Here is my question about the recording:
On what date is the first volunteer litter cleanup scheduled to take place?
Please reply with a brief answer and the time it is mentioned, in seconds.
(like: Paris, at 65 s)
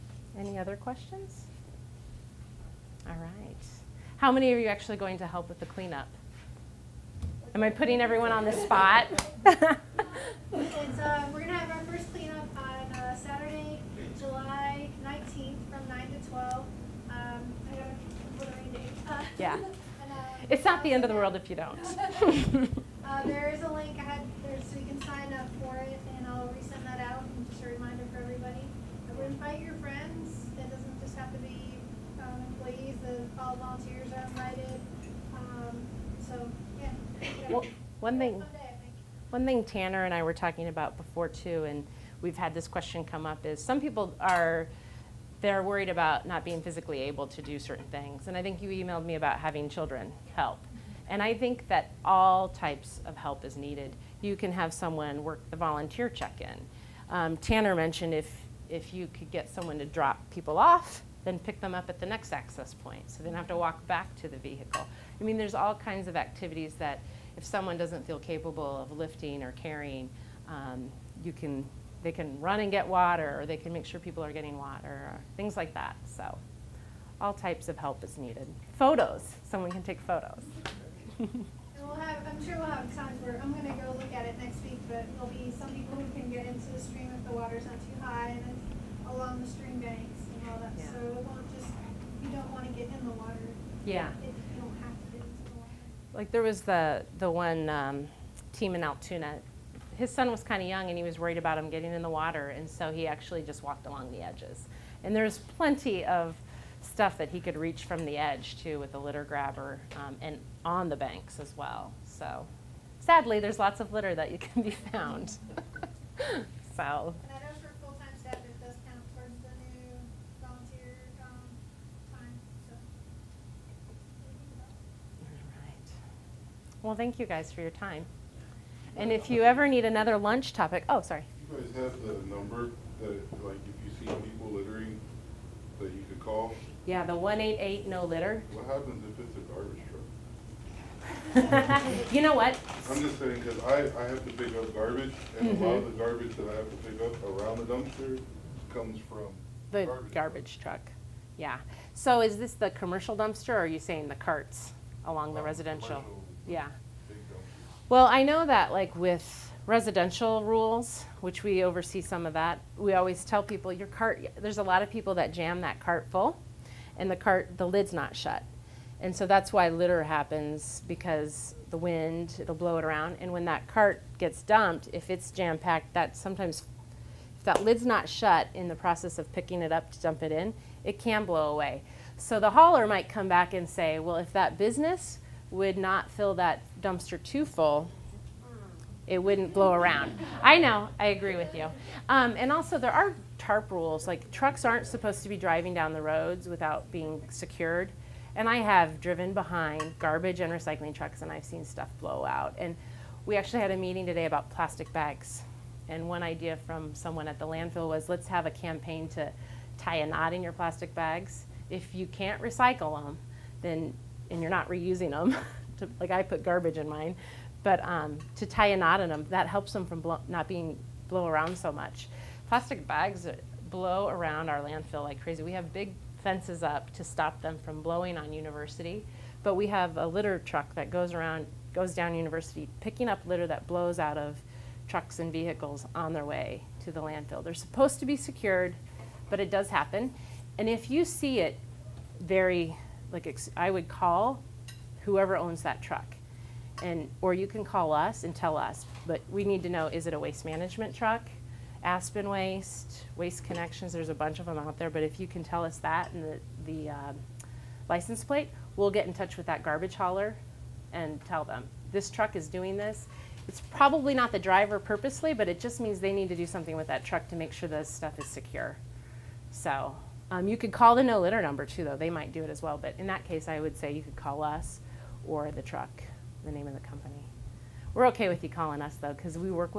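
Saturday, July 19th, at 13 s.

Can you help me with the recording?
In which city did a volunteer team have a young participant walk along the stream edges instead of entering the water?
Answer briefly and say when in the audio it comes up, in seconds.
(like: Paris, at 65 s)
Altoona, at 98 s.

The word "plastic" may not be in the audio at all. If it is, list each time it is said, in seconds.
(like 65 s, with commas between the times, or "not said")
204 s, 210 s, 222 s.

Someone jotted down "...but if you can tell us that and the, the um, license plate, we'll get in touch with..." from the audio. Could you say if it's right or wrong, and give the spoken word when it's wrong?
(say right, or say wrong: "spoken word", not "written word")
right.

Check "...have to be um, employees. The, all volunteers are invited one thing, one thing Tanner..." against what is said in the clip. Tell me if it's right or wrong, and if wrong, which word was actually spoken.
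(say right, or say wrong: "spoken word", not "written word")
right.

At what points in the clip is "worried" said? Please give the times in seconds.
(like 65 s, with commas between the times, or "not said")
45 s, 101 s.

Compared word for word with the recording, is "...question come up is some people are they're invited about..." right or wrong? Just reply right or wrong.
wrong.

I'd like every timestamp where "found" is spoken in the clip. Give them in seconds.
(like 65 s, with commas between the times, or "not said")
114 s.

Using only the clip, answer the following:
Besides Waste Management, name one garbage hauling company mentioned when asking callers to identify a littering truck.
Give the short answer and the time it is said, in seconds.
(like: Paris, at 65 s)
Aspen Waste, at 251 s.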